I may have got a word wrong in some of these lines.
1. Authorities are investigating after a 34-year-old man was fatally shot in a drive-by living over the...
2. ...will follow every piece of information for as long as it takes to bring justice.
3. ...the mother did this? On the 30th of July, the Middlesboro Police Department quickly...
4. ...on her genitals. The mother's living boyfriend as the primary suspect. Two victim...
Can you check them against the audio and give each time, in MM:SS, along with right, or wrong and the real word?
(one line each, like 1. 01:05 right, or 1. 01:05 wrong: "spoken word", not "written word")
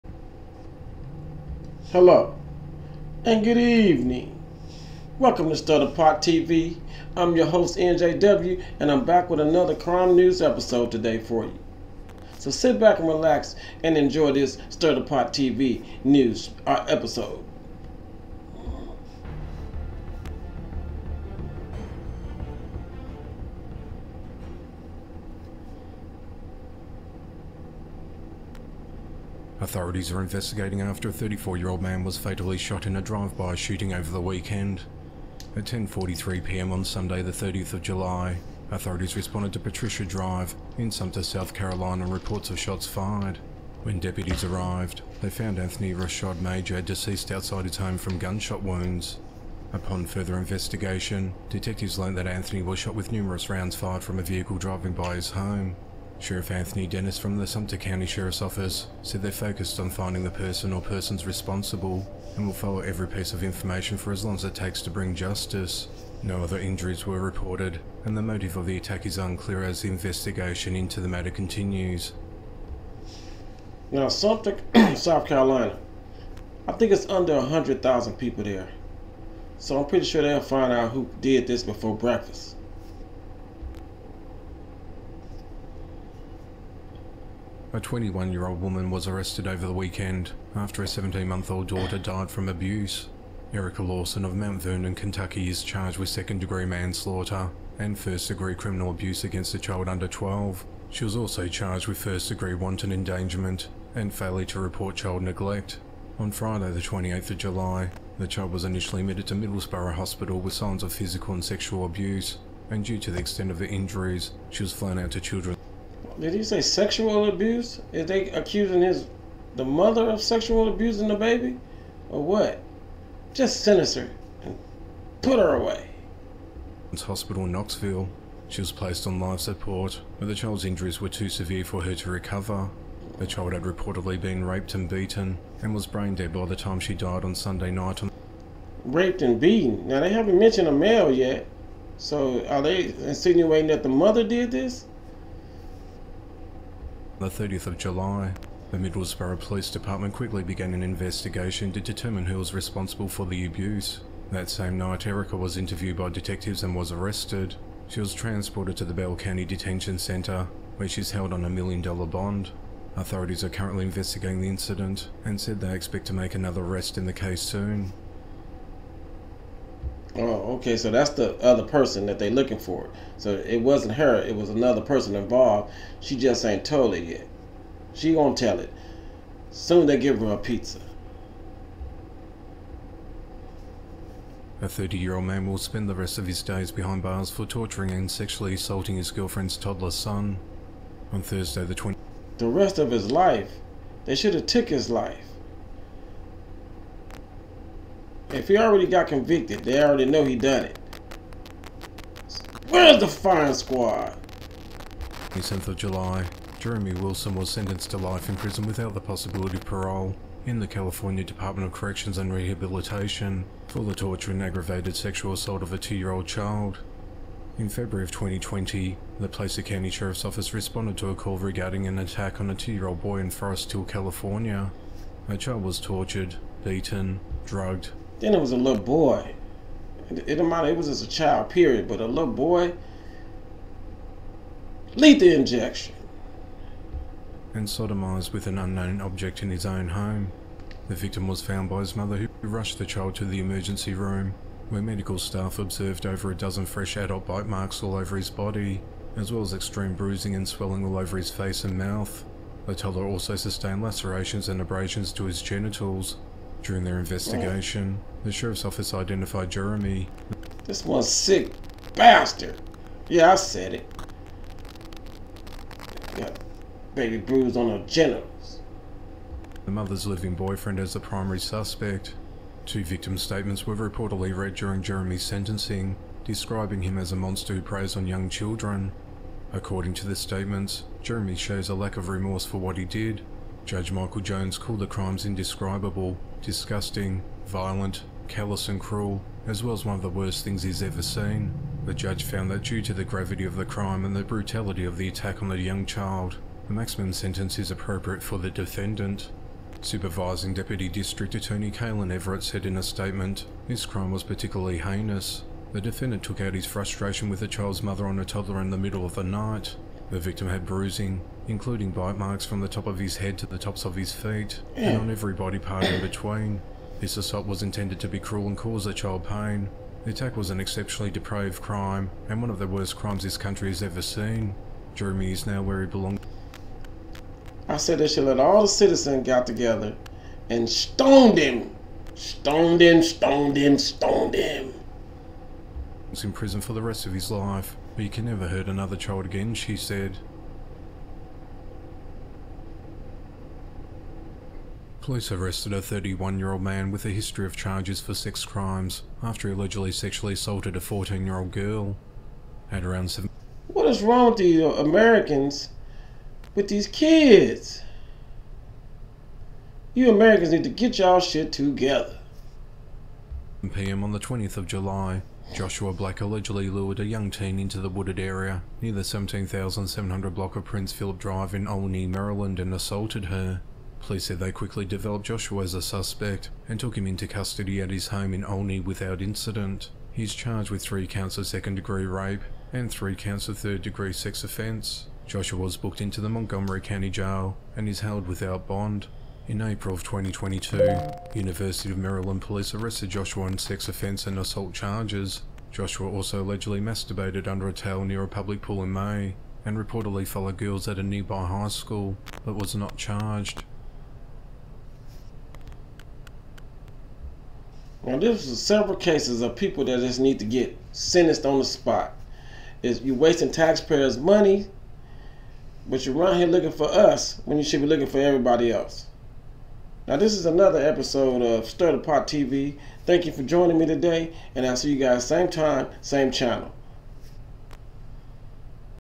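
1. 00:29 wrong: "shooting", not "living"
2. 01:02 right
3. 02:23 right
4. 04:27 right.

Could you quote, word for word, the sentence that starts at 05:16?
This assault was intended to be cruel and cause the child pain.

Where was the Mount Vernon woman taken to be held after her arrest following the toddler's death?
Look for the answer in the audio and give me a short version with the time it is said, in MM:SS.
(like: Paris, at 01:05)
Bell County Detention Centre, at 02:38.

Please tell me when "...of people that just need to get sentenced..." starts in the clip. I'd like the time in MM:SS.
06:49.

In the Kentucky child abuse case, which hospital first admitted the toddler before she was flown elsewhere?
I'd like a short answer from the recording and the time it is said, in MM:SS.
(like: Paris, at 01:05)
Middlesboro Hospital, at 01:49.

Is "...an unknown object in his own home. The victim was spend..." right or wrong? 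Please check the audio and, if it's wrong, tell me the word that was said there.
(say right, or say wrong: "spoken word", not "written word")
wrong: "found", not "spend".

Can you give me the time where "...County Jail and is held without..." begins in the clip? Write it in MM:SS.
06:26.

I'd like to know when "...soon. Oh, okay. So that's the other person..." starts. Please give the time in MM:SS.
02:47.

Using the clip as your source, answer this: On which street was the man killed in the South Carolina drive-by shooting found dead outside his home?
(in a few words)
Patricia Drive.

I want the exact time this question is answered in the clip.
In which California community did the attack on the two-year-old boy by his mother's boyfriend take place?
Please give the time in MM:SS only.
03:43.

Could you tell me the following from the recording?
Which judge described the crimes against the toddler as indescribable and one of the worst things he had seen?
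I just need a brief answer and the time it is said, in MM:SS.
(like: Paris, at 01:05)
Michael Jones, at 04:43.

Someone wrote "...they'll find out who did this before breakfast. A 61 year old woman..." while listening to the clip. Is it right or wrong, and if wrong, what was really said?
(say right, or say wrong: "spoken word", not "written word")
wrong: "21", not "61".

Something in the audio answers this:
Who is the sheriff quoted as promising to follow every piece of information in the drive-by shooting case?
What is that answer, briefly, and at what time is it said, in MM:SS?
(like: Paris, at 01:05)
Anthony Dennis, at 00:56.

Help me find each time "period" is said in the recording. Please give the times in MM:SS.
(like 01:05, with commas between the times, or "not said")
03:51.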